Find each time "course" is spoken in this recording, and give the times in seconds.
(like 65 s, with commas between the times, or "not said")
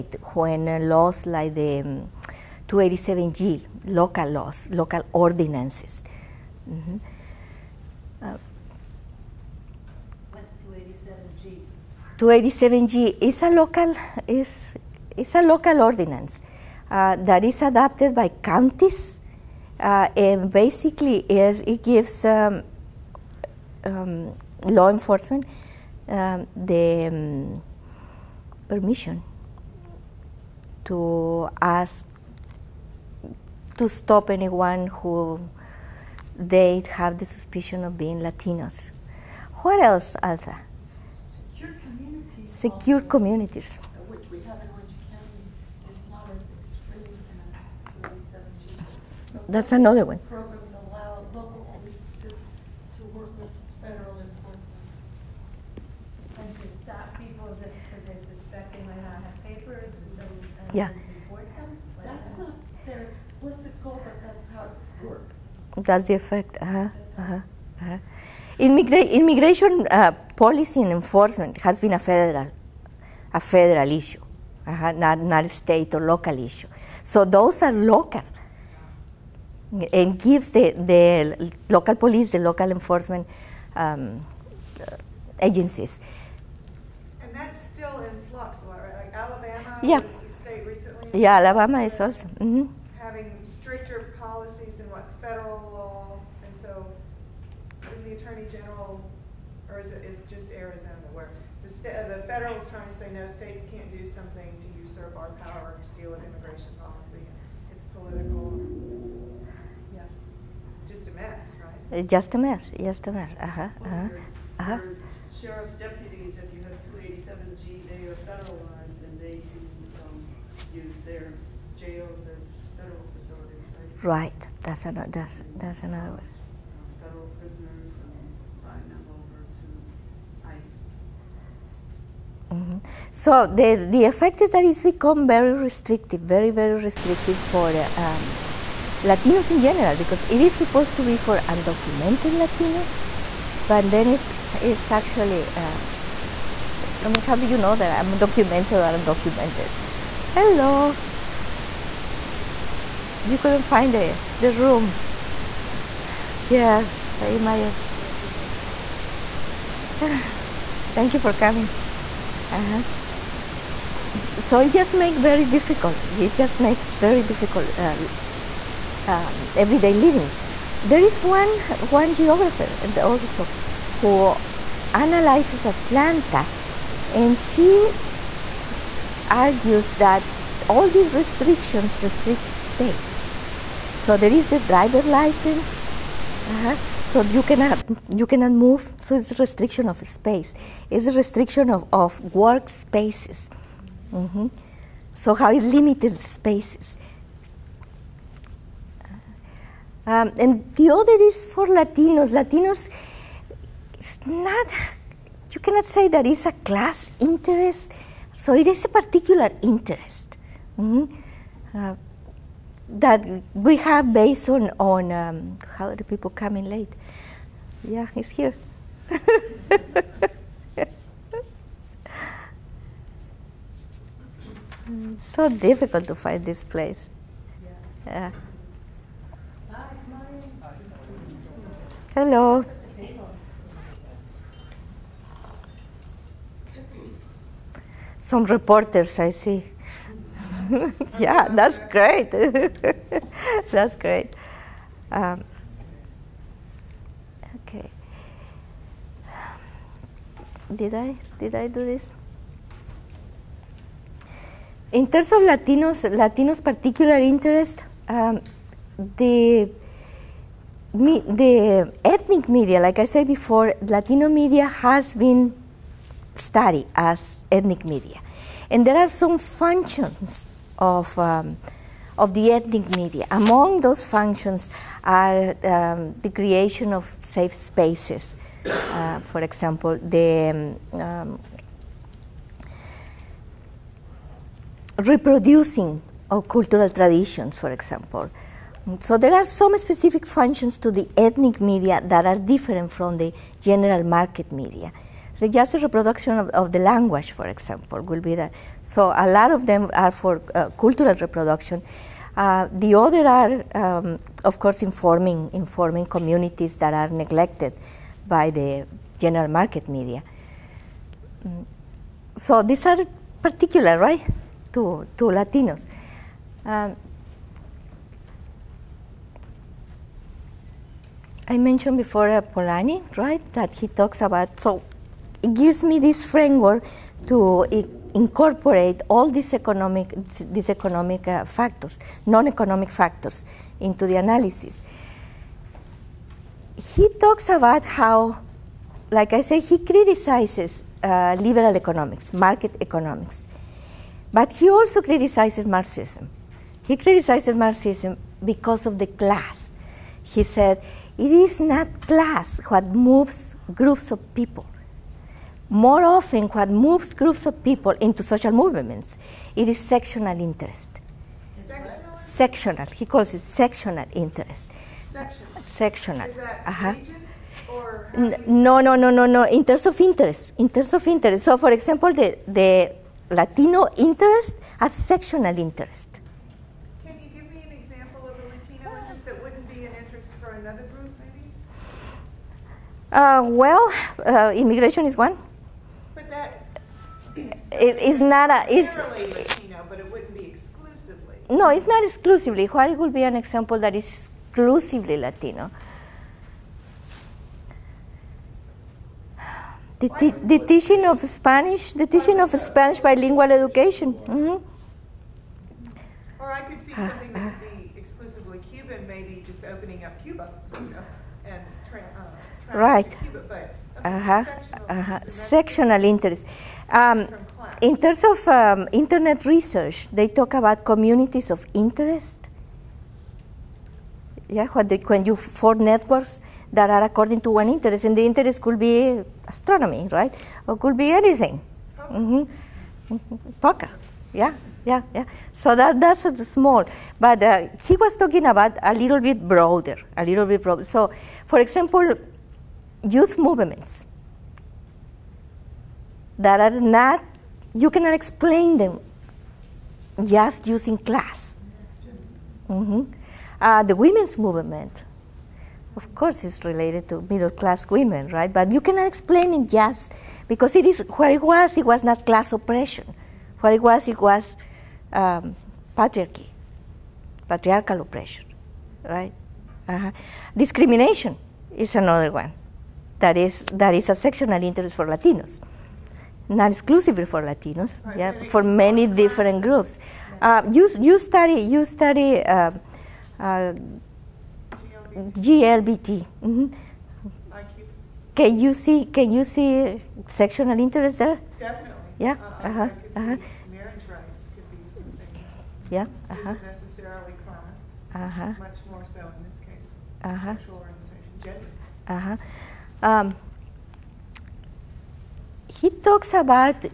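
304 s, 456 s.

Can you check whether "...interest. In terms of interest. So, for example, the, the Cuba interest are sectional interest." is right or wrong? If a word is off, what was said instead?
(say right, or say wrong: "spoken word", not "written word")
wrong: "Latino", not "Cuba".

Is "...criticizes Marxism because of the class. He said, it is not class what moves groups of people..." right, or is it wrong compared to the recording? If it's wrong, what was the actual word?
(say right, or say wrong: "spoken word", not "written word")
right.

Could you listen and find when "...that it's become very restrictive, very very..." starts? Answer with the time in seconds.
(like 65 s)
134 s.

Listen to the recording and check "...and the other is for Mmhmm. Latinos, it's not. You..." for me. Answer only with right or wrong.
wrong.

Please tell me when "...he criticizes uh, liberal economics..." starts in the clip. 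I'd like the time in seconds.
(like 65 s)
339 s.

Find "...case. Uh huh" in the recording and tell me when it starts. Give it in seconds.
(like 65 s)
499 s.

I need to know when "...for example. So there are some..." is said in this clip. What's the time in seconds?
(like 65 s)
287 s.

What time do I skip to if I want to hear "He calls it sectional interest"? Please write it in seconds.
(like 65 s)
362 s.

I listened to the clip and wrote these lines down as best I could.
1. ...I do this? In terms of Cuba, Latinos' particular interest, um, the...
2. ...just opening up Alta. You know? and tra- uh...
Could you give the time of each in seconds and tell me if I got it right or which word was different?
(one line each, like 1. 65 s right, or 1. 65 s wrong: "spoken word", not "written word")
1. 251 s wrong: "Latinos", not "Cuba"
2. 409 s wrong: "Cuba", not "Alta".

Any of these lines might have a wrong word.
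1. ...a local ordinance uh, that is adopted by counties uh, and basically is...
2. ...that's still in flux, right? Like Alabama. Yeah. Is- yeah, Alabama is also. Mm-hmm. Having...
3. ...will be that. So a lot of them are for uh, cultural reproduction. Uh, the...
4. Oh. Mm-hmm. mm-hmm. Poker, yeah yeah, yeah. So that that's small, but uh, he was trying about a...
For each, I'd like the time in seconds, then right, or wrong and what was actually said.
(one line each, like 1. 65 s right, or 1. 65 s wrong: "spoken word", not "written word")
1. 15 s right
2. 87 s right
3. 298 s right
4. 431 s wrong: "talking", not "trying".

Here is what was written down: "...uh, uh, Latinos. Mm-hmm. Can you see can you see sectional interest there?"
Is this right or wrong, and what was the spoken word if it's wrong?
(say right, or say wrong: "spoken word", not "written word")
wrong: "GLBT", not "Latinos".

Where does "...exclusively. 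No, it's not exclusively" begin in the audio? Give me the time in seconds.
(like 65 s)
390 s.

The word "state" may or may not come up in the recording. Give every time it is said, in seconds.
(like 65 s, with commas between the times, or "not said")
75 s, 103 s.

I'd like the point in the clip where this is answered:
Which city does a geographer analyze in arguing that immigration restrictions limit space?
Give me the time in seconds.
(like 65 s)
175 s.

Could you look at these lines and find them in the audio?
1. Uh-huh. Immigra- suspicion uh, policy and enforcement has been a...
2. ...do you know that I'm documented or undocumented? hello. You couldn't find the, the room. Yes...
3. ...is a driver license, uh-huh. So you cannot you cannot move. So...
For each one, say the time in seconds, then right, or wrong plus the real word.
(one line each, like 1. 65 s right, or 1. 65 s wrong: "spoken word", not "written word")
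1. 67 s wrong: "immigration", not "suspicion"
2. 147 s right
3. 184 s right.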